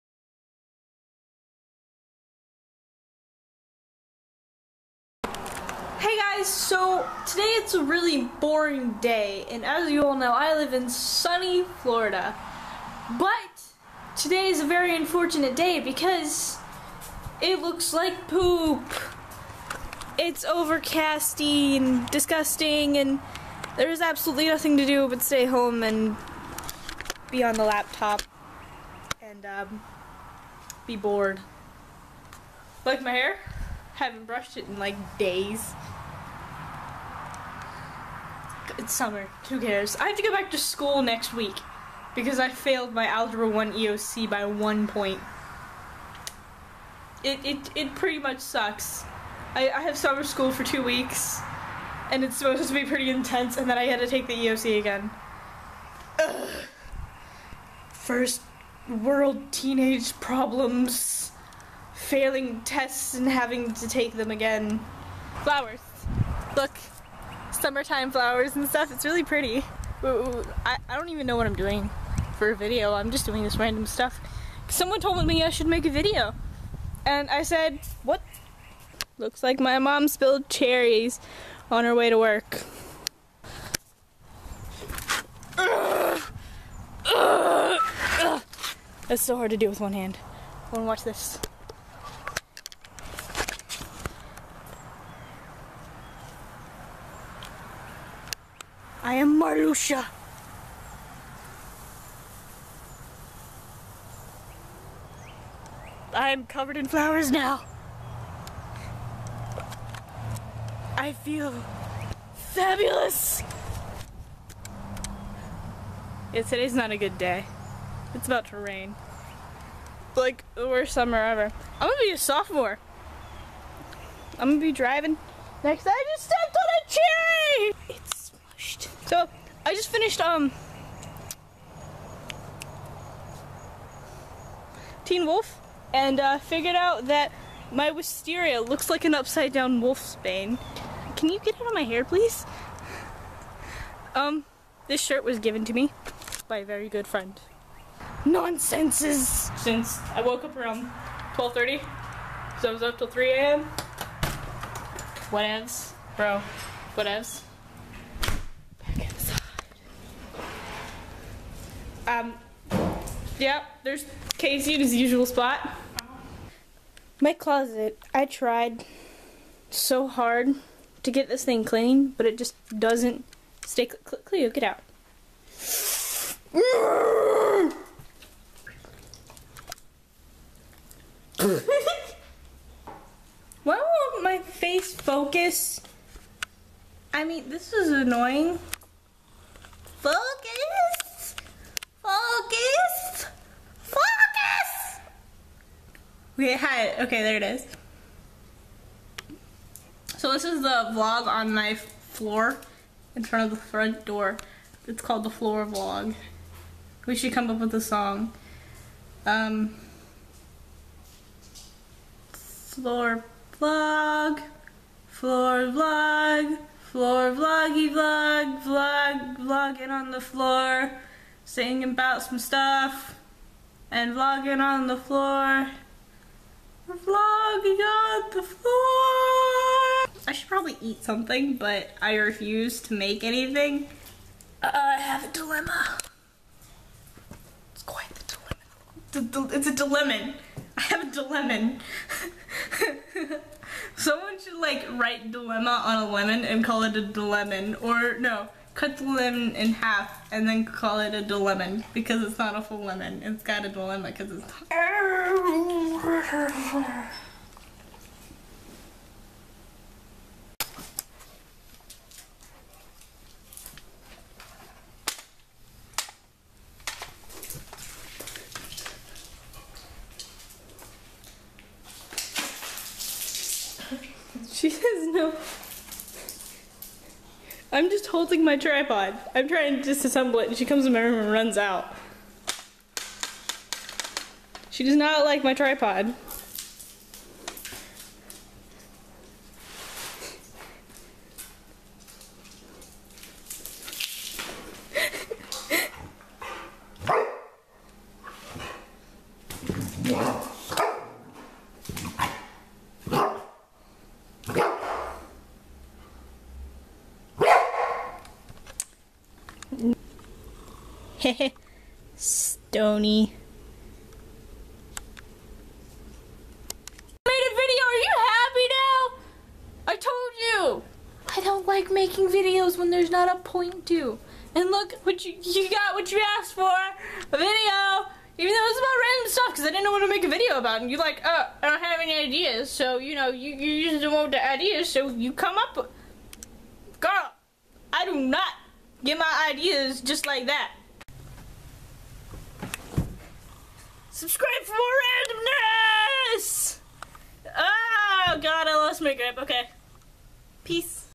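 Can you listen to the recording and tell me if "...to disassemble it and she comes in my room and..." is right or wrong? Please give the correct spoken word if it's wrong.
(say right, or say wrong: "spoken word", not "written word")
right.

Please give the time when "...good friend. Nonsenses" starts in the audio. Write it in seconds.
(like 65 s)
146 s.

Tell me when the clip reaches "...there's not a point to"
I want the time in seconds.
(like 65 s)
322 s.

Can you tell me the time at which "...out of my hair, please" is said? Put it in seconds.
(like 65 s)
141 s.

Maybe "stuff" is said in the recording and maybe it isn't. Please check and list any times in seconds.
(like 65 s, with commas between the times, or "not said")
68 s, 73 s, 222 s, 329 s.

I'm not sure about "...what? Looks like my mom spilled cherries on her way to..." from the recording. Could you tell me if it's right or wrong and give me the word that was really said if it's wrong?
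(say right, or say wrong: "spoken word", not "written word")
right.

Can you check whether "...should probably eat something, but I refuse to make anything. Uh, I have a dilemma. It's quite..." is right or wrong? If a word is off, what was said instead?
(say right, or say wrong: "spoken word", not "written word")
right.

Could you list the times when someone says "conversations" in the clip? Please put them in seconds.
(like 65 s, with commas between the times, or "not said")
not said.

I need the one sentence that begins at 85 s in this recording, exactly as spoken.
It's That's so hard to do with one hand.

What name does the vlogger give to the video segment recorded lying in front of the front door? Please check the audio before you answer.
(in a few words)
the floor vlog.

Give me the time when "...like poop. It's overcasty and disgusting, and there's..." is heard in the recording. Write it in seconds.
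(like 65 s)
17 s.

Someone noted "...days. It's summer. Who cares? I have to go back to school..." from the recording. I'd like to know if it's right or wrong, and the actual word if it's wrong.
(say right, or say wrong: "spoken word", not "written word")
right.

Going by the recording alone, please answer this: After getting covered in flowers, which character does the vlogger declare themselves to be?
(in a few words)
Marluxia.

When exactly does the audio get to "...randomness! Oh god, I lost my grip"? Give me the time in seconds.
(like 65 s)
345 s.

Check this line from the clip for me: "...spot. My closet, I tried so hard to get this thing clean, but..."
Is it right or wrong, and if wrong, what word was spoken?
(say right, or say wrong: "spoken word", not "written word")
right.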